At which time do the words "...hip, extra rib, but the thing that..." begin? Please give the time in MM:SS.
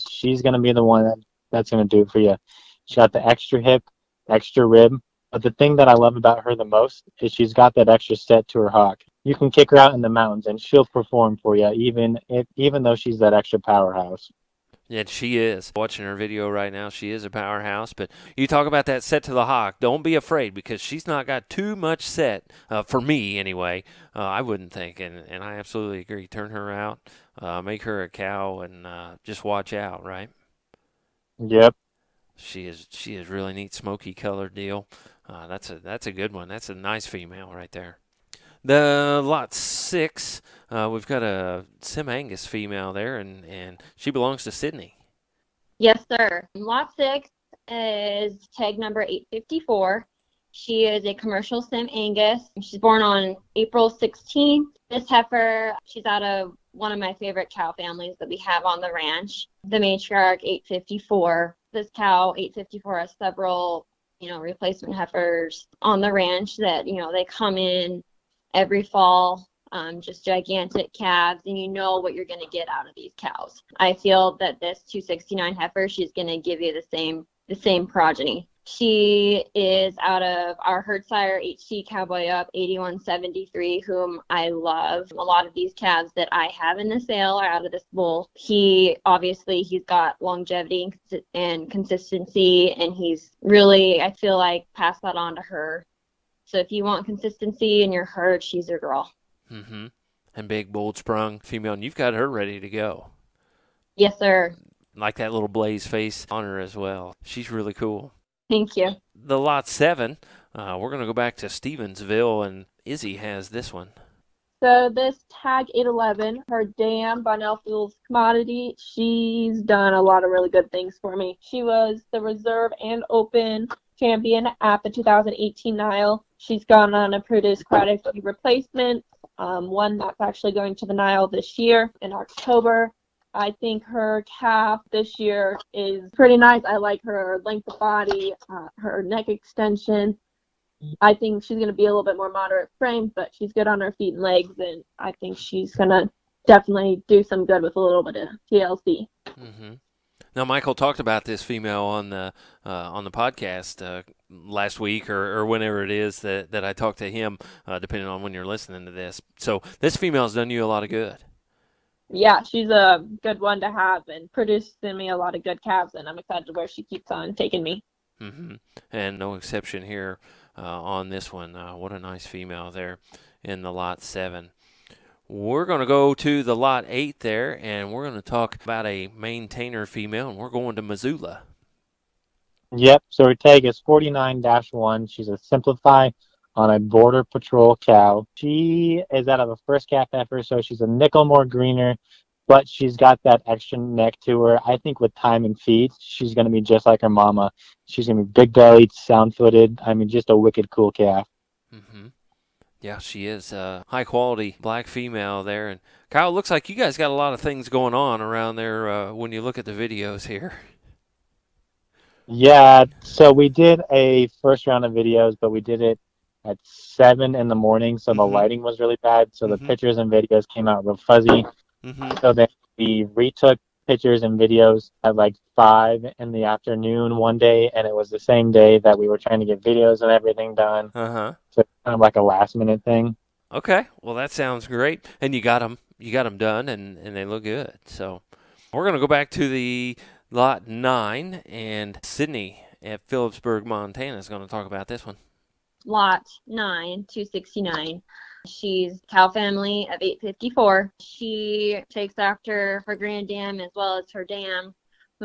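00:03.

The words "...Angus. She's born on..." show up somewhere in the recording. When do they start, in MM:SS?
00:51.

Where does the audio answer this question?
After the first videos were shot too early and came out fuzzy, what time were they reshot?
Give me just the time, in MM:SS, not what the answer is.
03:45.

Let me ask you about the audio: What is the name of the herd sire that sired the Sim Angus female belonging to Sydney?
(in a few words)
HC Cowboy Up 8173.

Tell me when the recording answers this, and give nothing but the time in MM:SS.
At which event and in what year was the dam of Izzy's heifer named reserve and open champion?
02:04.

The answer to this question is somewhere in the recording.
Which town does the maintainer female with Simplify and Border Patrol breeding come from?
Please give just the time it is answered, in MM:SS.
03:00.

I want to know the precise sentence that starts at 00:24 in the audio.
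Uh, I wouldn't think, and and I absolutely agree.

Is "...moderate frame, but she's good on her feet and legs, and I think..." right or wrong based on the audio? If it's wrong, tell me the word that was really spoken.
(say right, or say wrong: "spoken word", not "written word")
right.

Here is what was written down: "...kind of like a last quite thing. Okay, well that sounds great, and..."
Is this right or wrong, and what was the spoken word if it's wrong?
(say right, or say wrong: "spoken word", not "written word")
wrong: "minute", not "quite".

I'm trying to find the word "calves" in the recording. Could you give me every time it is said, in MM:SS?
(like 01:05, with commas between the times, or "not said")
01:10, 01:25, 02:45.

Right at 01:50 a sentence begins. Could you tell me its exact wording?
Uh, we're going to go back to Stevensville, and Izzy has this one.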